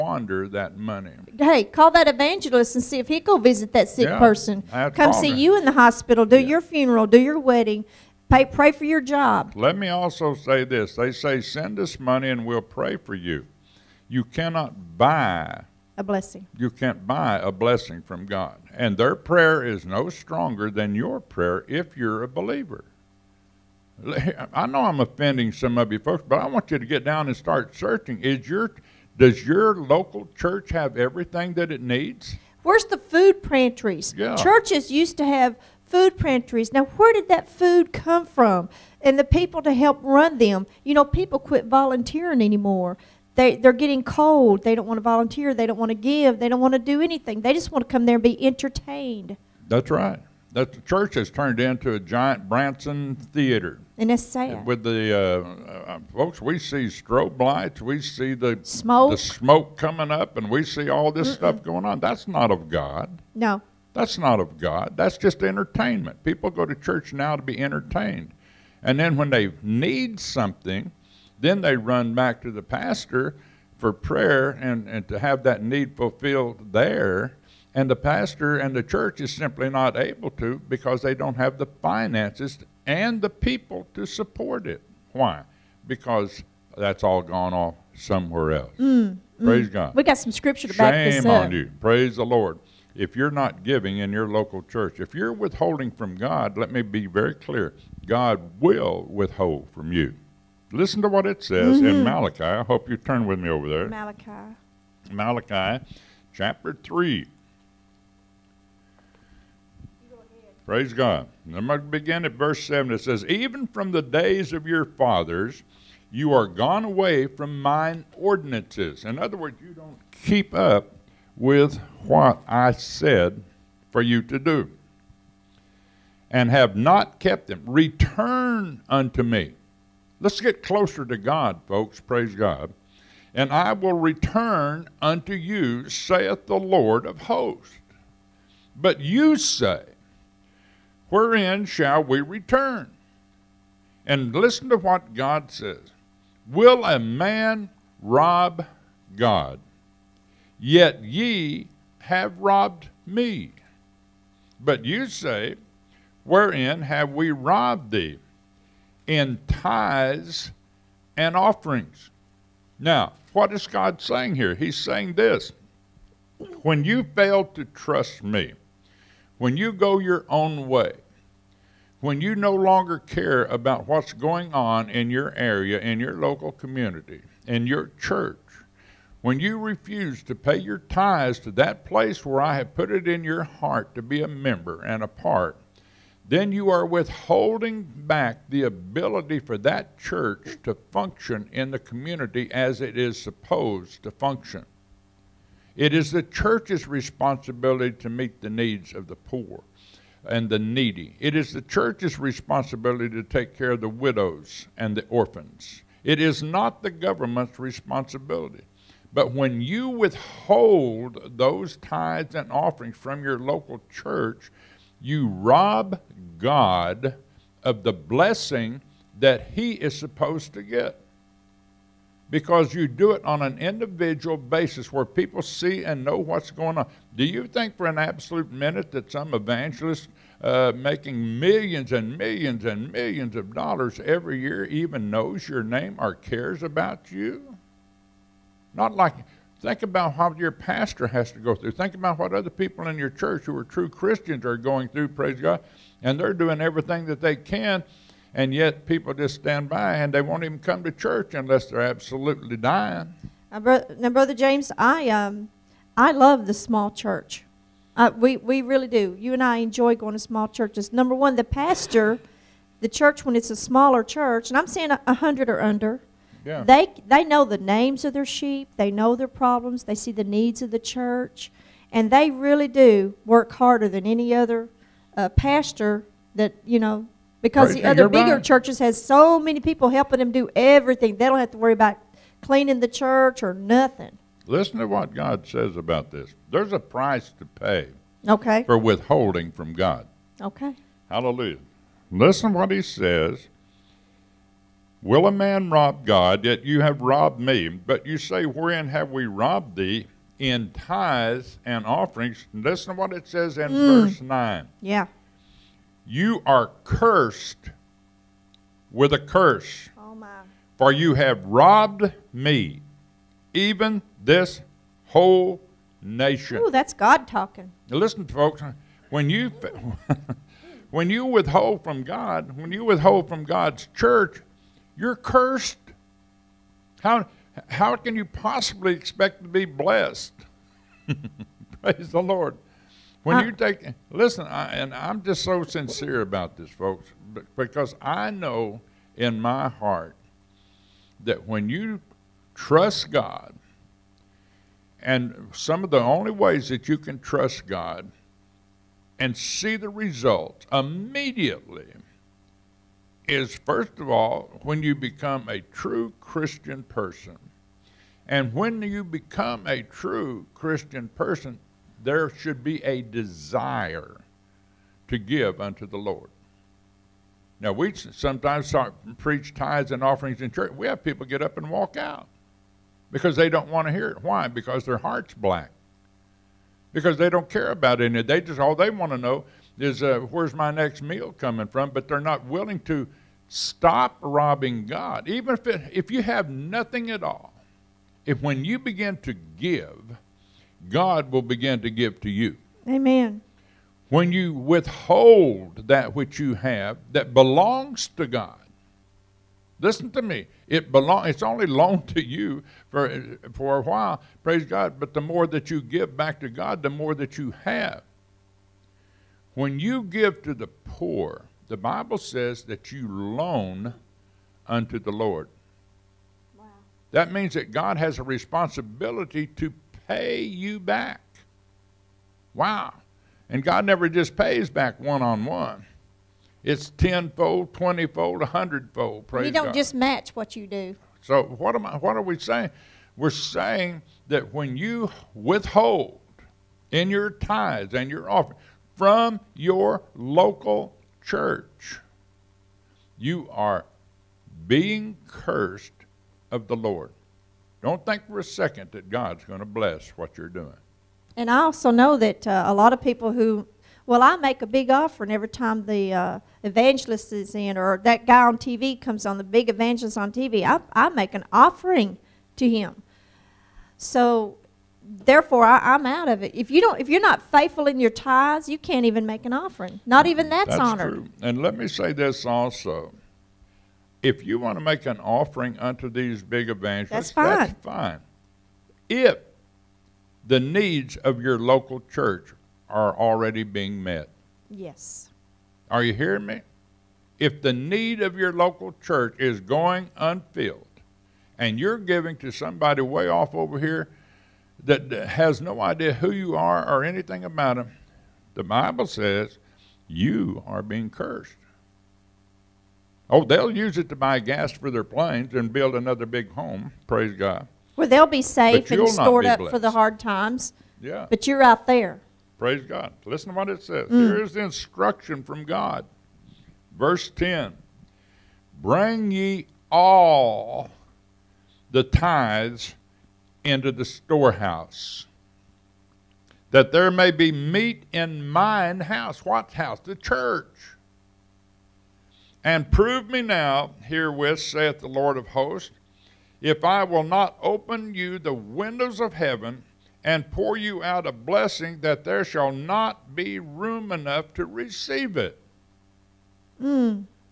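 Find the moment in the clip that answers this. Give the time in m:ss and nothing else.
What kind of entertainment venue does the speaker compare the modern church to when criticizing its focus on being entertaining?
0:52.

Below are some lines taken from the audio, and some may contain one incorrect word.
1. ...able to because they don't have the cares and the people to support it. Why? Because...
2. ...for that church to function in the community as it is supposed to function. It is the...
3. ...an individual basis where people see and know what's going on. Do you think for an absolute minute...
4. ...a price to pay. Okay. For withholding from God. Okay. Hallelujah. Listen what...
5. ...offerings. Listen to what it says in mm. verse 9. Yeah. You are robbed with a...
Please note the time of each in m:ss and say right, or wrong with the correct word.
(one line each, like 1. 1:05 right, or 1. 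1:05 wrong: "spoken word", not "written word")
1. 1:19 wrong: "finances", not "cares"
2. 3:09 right
3. 3:43 right
4. 4:46 right
5. 5:01 wrong: "cursed", not "robbed".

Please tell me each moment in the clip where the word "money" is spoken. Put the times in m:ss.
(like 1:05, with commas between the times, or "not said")
0:00, 0:11.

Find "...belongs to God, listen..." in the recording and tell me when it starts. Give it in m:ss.
6:37.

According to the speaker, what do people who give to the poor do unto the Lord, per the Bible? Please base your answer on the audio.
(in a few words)
Loan.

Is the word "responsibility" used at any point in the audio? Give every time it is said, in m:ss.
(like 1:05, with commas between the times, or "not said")
3:16, 3:22, 3:27, 6:58.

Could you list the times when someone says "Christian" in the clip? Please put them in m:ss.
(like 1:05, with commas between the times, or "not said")
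4:03, 5:56, 6:00.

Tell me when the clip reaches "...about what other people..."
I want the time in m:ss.
4:01.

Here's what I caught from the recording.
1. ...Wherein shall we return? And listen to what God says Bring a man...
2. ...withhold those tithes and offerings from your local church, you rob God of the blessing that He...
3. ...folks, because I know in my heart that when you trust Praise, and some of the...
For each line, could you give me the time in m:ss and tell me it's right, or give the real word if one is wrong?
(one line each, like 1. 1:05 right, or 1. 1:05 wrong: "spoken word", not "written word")
1. 2:21 wrong: "Will", not "Bring"
2. 3:29 right
3. 5:36 wrong: "God", not "Praise".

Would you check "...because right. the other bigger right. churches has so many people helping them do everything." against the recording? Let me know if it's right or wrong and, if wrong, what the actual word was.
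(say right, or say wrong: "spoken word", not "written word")
right.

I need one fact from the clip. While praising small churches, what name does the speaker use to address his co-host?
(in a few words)
Brother James.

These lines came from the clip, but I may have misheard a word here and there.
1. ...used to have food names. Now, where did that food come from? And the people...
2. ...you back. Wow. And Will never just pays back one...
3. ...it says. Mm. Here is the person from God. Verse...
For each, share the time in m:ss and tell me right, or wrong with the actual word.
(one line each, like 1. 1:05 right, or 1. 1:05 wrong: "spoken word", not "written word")
1. 0:34 wrong: "pantries", not "names"
2. 7:00 wrong: "God", not "Will"
3. 8:33 wrong: "instruction", not "person".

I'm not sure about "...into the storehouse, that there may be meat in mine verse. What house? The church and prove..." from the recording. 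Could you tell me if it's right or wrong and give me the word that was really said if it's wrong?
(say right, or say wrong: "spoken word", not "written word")
wrong: "house", not "verse".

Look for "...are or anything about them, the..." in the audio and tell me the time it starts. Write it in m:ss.
8:16.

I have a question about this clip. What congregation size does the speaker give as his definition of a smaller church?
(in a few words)
100 or under.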